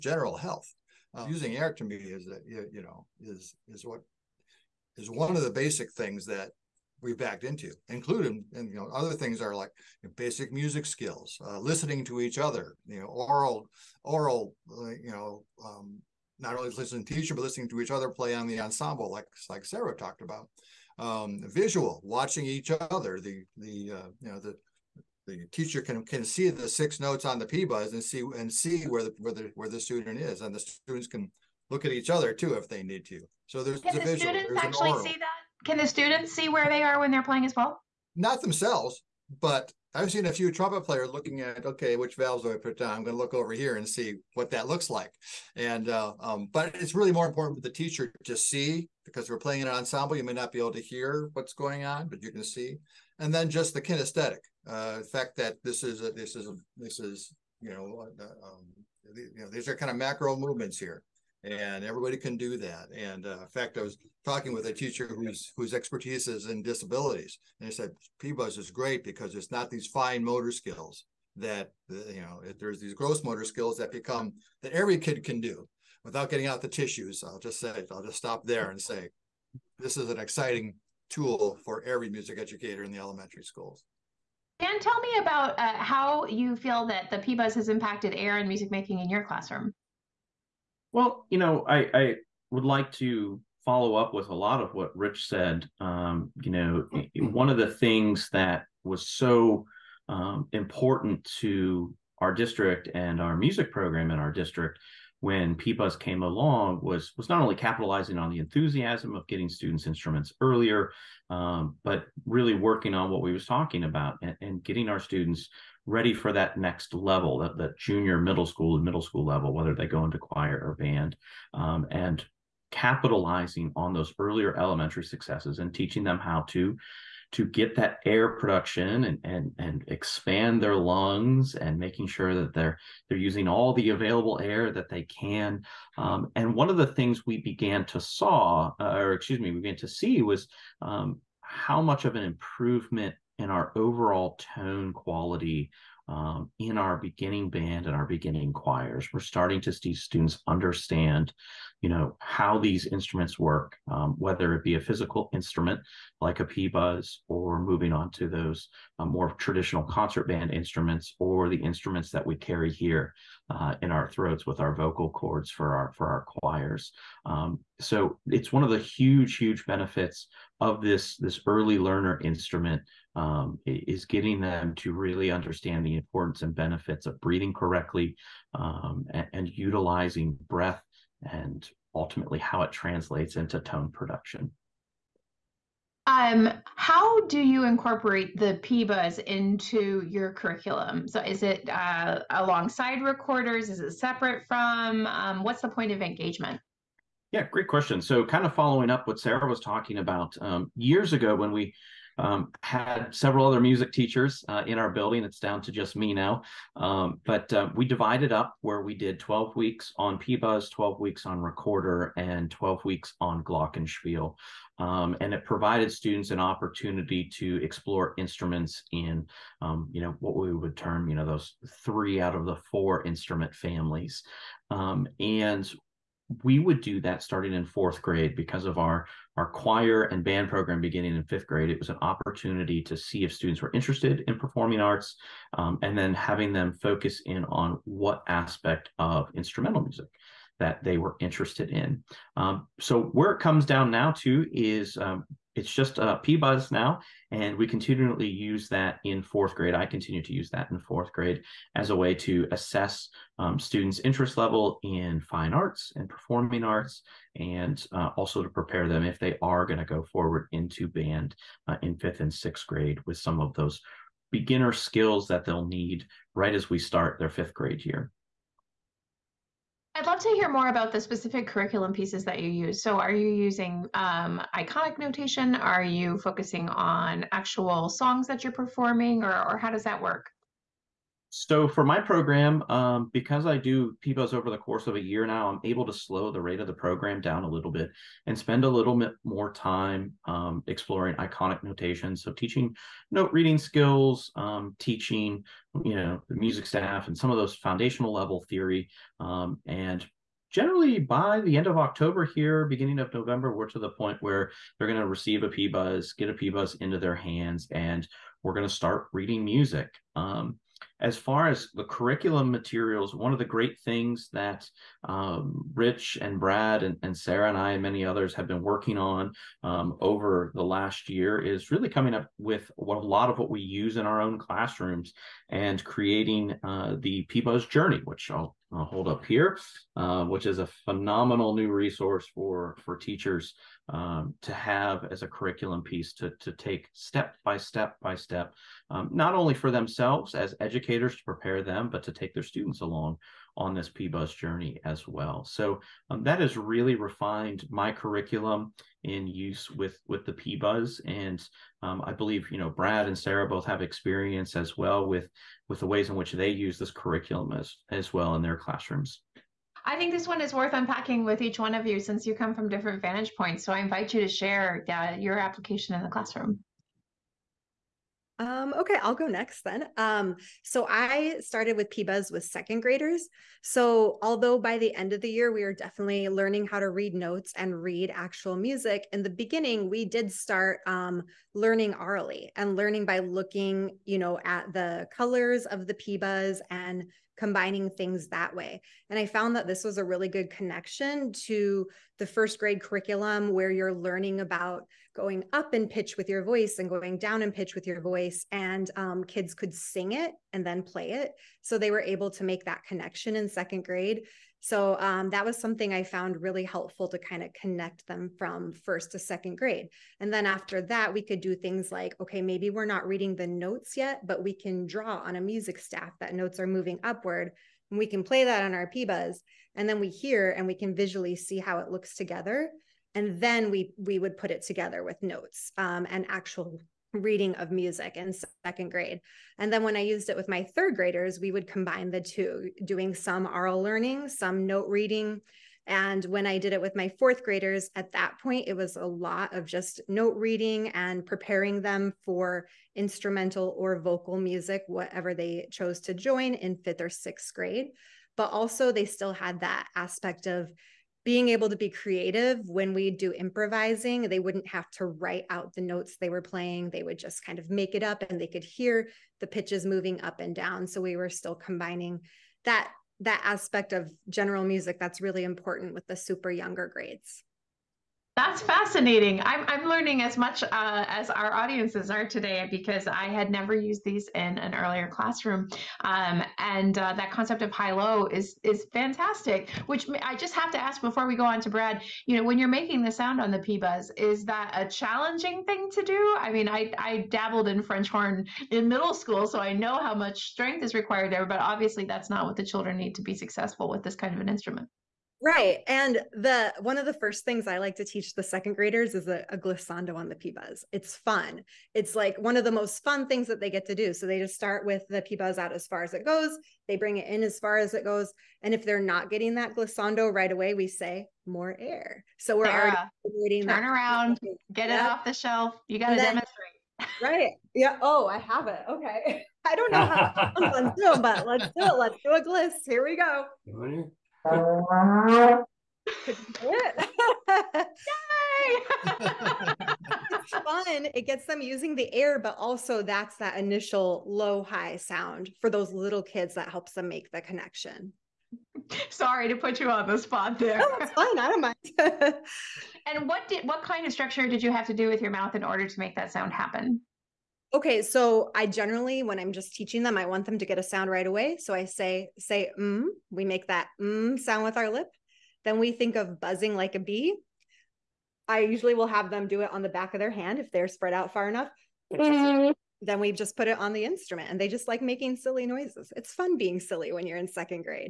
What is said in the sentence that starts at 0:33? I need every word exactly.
So there's a the, visual, students actually oral.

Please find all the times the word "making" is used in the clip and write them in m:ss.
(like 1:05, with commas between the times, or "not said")
1:28, 2:11, 8:02, 9:25.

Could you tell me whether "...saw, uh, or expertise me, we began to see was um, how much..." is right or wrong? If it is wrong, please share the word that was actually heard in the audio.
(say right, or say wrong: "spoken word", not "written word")
wrong: "excuse", not "expertise".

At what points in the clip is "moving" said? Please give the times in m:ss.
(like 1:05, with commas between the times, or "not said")
2:37, 6:56, 7:39.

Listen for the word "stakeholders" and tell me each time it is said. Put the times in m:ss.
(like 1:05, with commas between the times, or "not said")
not said.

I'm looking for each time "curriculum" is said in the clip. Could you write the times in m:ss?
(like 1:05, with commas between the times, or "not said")
3:10, 4:31, 5:11, 5:35, 5:47, 5:56, 6:32.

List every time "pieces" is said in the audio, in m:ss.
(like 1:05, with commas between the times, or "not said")
4:31, 5:35.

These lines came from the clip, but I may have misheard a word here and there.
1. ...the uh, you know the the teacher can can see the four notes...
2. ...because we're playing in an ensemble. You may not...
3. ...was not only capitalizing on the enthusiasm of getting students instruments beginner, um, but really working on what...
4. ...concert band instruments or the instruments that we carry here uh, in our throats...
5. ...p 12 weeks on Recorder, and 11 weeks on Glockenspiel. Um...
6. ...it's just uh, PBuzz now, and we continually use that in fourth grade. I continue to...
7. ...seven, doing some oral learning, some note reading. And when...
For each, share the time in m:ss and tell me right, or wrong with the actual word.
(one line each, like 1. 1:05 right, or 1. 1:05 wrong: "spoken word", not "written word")
1. 0:23 wrong: "six", not "four"
2. 0:49 right
3. 1:47 wrong: "earlier", not "beginner"
4. 2:39 right
5. 3:30 wrong: "12", not "11"
6. 4:05 right
7. 7:12 wrong: "two", not "seven".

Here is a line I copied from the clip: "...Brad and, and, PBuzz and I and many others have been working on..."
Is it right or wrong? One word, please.
wrong.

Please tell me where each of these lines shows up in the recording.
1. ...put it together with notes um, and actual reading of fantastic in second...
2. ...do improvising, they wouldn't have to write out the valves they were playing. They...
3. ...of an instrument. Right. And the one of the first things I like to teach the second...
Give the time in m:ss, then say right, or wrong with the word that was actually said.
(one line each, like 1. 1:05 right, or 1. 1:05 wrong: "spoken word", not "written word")
1. 7:04 wrong: "music", not "fantastic"
2. 7:33 wrong: "notes", not "valves"
3. 8:14 right.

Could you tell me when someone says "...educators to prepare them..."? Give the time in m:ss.
5:40.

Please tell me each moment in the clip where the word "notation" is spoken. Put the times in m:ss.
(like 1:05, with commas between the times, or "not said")
4:34, 4:51.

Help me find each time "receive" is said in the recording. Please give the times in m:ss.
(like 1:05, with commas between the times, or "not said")
5:05.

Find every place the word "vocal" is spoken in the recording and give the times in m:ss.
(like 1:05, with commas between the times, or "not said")
2:44, 7:23.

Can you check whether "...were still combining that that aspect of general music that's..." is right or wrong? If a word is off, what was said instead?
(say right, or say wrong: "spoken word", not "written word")
right.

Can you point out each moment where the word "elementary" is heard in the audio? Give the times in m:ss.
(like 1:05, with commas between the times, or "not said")
1:22, 2:04.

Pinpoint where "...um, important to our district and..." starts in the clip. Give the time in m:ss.
1:40.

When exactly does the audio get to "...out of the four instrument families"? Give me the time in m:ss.
3:42.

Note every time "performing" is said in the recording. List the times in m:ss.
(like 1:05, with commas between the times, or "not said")
3:54, 4:16, 4:38.